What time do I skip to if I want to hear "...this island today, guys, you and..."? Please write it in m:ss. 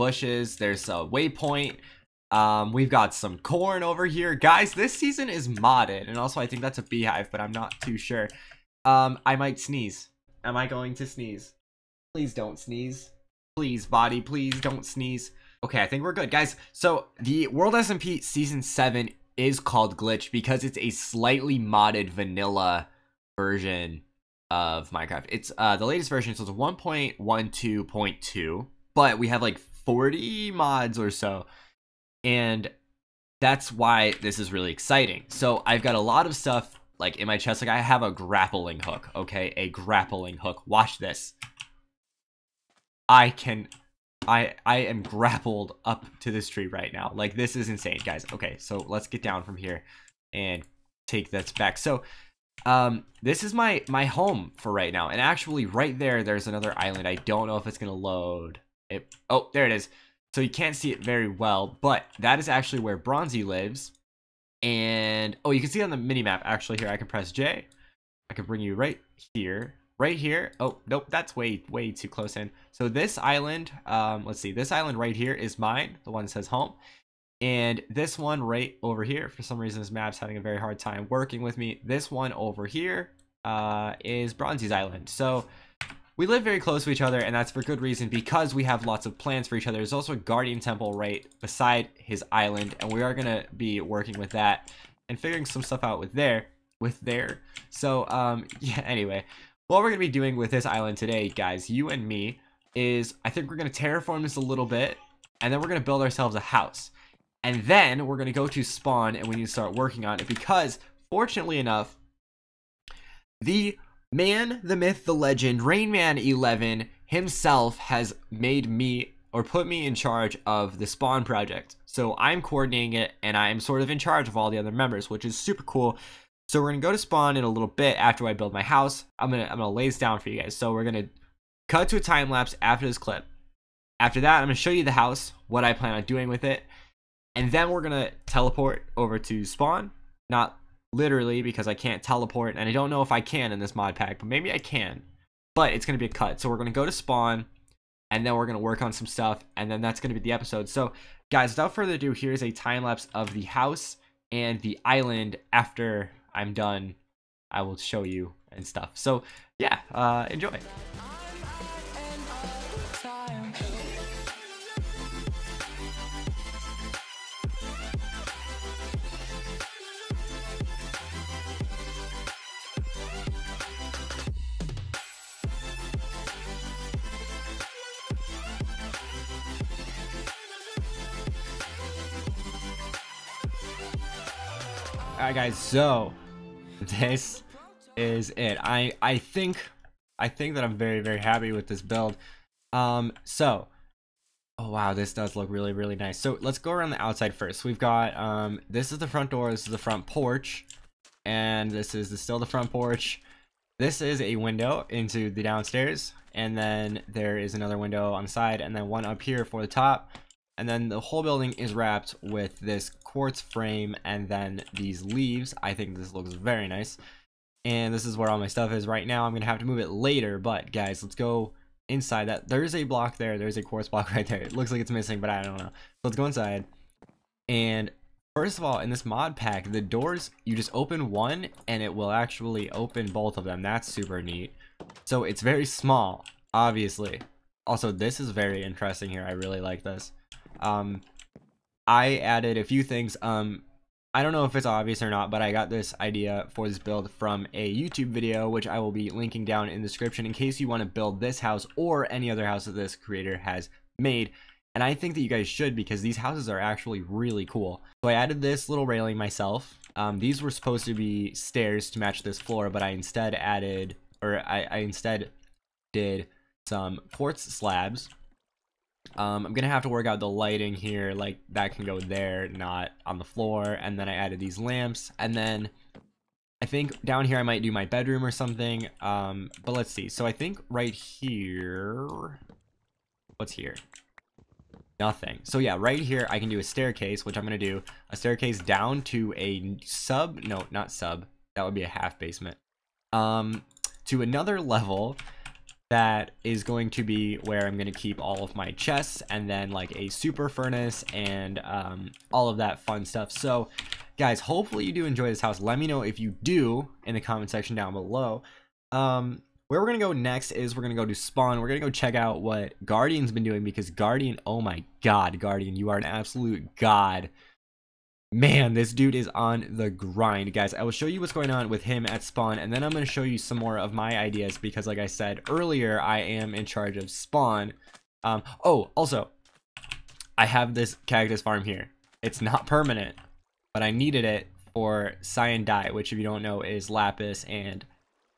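1:40.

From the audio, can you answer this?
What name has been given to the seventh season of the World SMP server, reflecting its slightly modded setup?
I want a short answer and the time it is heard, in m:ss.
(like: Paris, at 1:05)
Glitch, at 0:19.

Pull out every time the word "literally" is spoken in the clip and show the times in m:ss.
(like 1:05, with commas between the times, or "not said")
2:20.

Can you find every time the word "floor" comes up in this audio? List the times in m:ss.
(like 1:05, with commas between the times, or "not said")
4:22, 4:33.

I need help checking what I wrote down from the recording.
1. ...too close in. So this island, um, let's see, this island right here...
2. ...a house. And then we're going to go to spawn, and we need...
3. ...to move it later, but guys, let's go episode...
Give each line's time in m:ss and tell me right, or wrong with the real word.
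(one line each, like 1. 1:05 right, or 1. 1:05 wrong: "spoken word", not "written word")
1. 1:11 right
2. 1:46 right
3. 3:39 wrong: "inside", not "episode".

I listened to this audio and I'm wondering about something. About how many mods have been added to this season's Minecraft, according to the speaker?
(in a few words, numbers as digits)
40.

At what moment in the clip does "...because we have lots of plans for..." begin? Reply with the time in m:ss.
1:28.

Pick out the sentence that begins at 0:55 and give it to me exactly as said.
And actually right there there's another island.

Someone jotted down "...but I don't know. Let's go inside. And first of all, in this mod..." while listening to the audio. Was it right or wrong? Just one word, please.
right.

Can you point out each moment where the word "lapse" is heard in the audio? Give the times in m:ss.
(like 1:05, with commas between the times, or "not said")
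2:12, 2:32.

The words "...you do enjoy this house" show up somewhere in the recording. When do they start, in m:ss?
5:04.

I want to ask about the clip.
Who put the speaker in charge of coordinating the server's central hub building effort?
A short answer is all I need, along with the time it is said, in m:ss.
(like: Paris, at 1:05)
RaineMan11, at 1:55.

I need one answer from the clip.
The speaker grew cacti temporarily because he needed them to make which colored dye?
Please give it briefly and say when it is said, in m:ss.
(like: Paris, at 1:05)
Cyan, at 5:35.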